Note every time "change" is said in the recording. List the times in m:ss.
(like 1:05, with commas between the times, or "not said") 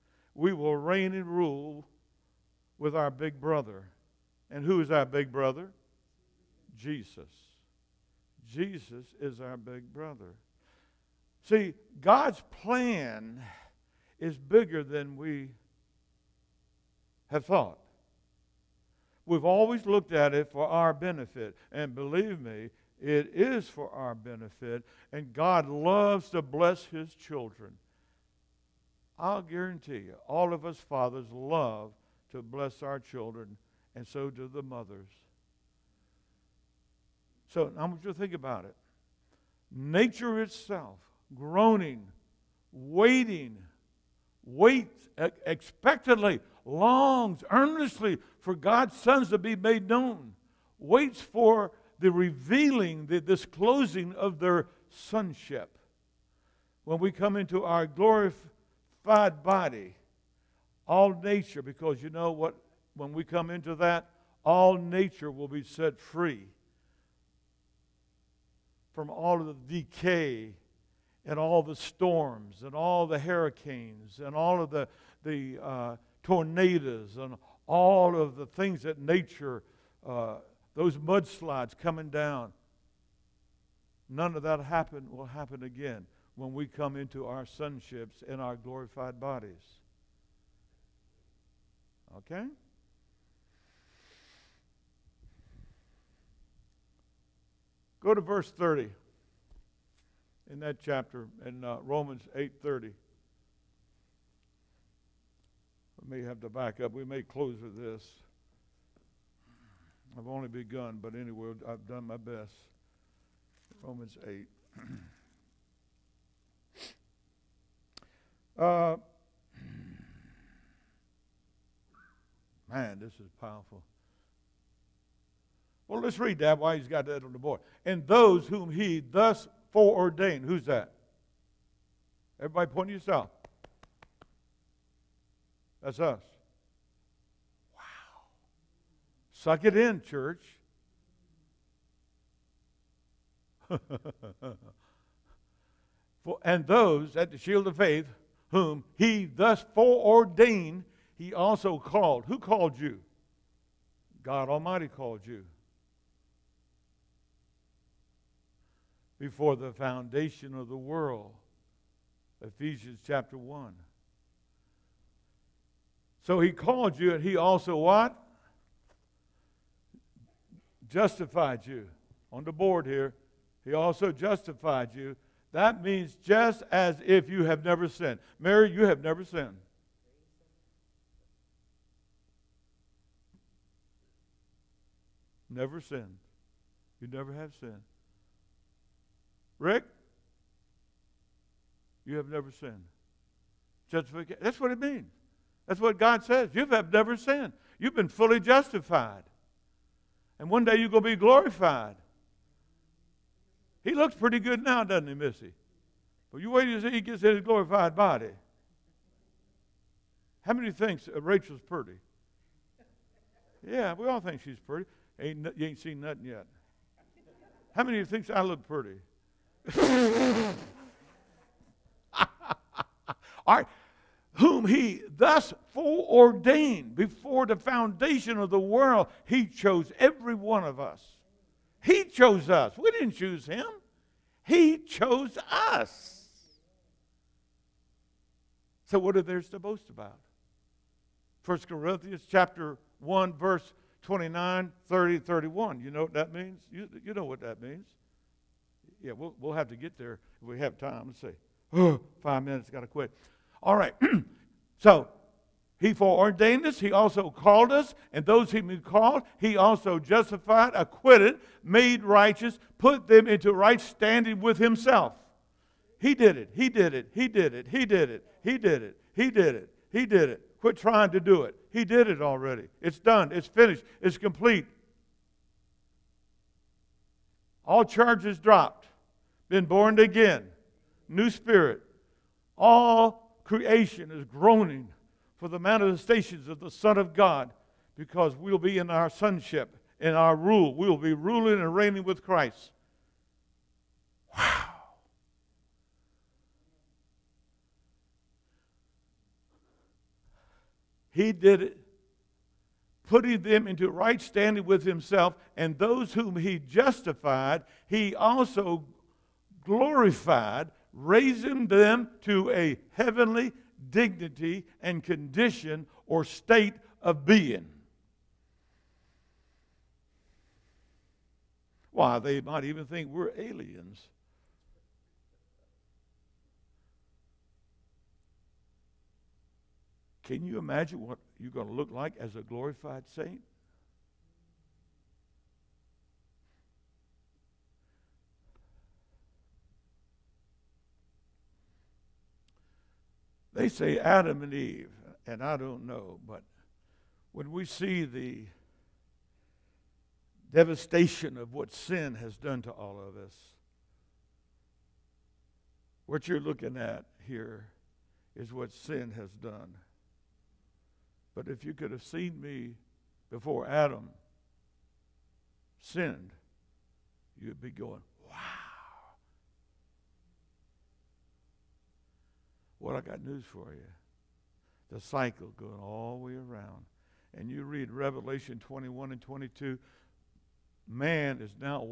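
not said.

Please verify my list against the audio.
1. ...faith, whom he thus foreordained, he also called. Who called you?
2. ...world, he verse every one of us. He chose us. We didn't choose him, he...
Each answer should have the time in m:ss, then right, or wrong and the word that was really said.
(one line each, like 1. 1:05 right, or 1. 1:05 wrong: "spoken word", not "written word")
1. 2:27 right
2. 3:48 wrong: "chose", not "verse".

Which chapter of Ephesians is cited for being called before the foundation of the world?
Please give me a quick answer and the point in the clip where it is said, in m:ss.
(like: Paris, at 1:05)
Chapter 1, at 2:42.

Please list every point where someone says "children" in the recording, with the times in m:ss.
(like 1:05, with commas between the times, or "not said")
0:27, 0:32.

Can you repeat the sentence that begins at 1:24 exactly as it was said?
None of that happen will happen again when we come into our sonships and our glorified bodies.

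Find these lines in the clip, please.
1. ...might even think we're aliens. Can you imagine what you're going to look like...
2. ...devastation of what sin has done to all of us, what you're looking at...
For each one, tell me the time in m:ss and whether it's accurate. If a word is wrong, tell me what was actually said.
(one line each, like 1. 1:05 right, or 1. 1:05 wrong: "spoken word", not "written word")
1. 5:22 right
2. 5:50 right.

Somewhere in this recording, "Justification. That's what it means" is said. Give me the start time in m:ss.
3:13.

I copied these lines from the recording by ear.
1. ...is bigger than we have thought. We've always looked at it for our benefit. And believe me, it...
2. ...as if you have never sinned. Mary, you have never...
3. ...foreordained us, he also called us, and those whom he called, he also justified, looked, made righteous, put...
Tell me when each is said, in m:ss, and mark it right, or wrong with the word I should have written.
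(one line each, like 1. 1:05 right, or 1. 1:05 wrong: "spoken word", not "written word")
1. 0:14 right
2. 2:56 right
3. 4:15 wrong: "acquitted", not "looked".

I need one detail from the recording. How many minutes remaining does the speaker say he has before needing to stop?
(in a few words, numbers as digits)
5.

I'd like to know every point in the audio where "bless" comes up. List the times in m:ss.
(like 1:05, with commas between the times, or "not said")
0:26, 0:32.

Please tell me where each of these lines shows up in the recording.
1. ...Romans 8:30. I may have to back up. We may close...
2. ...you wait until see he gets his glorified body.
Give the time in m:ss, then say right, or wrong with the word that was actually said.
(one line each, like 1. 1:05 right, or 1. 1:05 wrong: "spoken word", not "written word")
1. 1:41 right
2. 3:26 right.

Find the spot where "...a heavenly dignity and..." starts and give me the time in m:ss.
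5:12.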